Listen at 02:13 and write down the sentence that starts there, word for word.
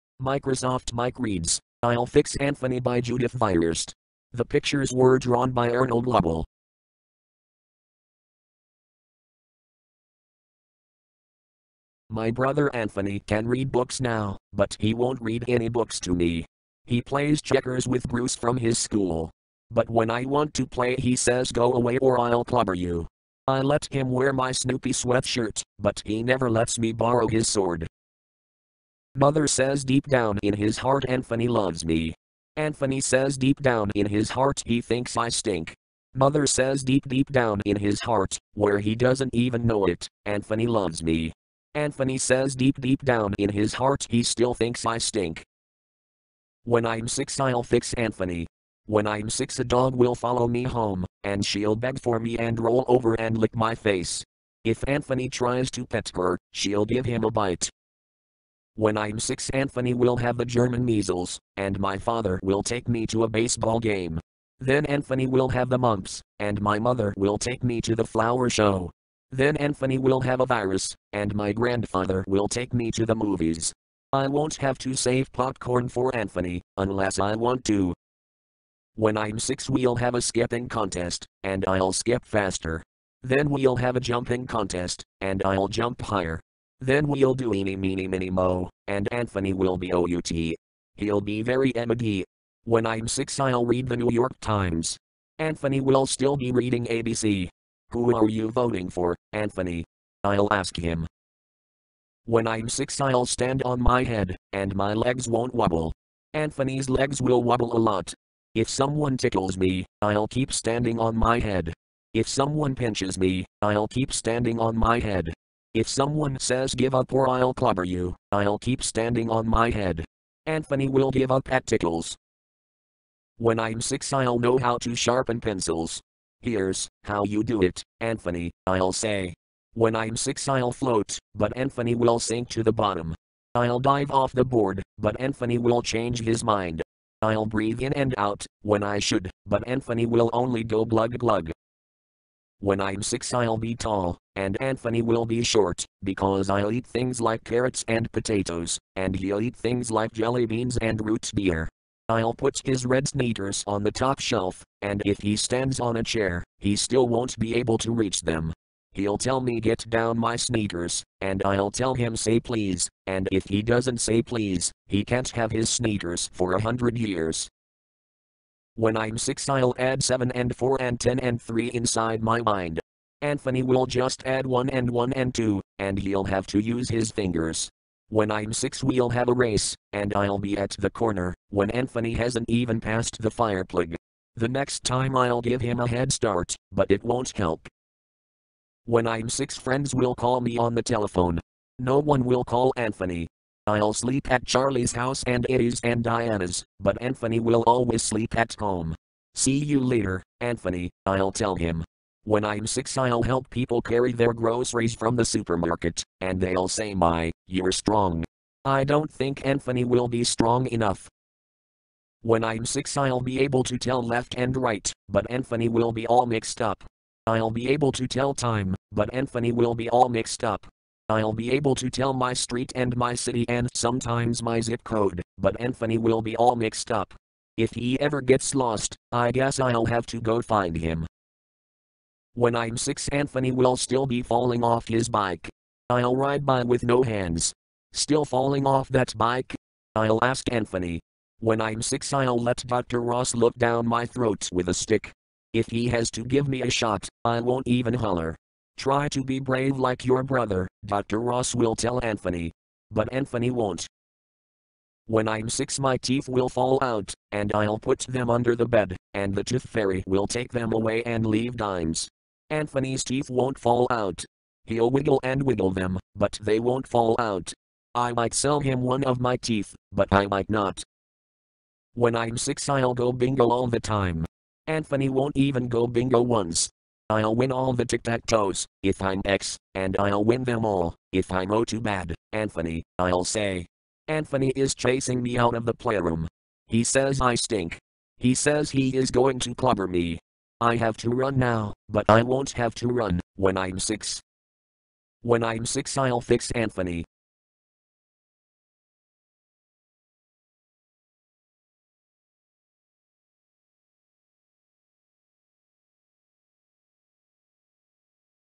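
I'll dive off the board, but Anthony will change his mind.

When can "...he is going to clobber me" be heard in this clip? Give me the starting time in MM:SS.
04:48.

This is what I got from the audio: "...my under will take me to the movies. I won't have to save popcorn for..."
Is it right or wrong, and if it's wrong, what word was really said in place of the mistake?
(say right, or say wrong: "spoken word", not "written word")
wrong: "grandfather", not "under".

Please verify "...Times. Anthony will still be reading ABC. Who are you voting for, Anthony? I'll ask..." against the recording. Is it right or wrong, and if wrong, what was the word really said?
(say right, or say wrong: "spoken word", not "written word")
right.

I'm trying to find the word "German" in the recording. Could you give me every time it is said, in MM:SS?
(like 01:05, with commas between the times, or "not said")
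01:00.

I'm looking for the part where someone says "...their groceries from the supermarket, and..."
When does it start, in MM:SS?
03:24.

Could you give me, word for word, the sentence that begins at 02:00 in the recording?
Anthony will give up at tickles.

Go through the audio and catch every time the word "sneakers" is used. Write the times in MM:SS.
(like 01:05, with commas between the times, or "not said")
02:33, 02:40, 02:45.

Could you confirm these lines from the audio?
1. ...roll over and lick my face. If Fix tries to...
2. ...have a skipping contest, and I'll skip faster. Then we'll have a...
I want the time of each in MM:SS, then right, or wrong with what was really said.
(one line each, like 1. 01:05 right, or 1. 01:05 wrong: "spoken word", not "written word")
1. 00:52 wrong: "Anthony", not "Fix"
2. 01:19 right.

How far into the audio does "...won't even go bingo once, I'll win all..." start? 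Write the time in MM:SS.
04:35.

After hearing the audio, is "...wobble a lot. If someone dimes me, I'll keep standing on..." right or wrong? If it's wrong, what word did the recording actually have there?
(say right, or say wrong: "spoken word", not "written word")
wrong: "tickles", not "dimes".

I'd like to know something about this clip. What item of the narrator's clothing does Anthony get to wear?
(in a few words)
Snoopy sweatshirt.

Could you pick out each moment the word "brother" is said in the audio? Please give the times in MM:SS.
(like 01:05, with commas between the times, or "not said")
00:12, 04:10.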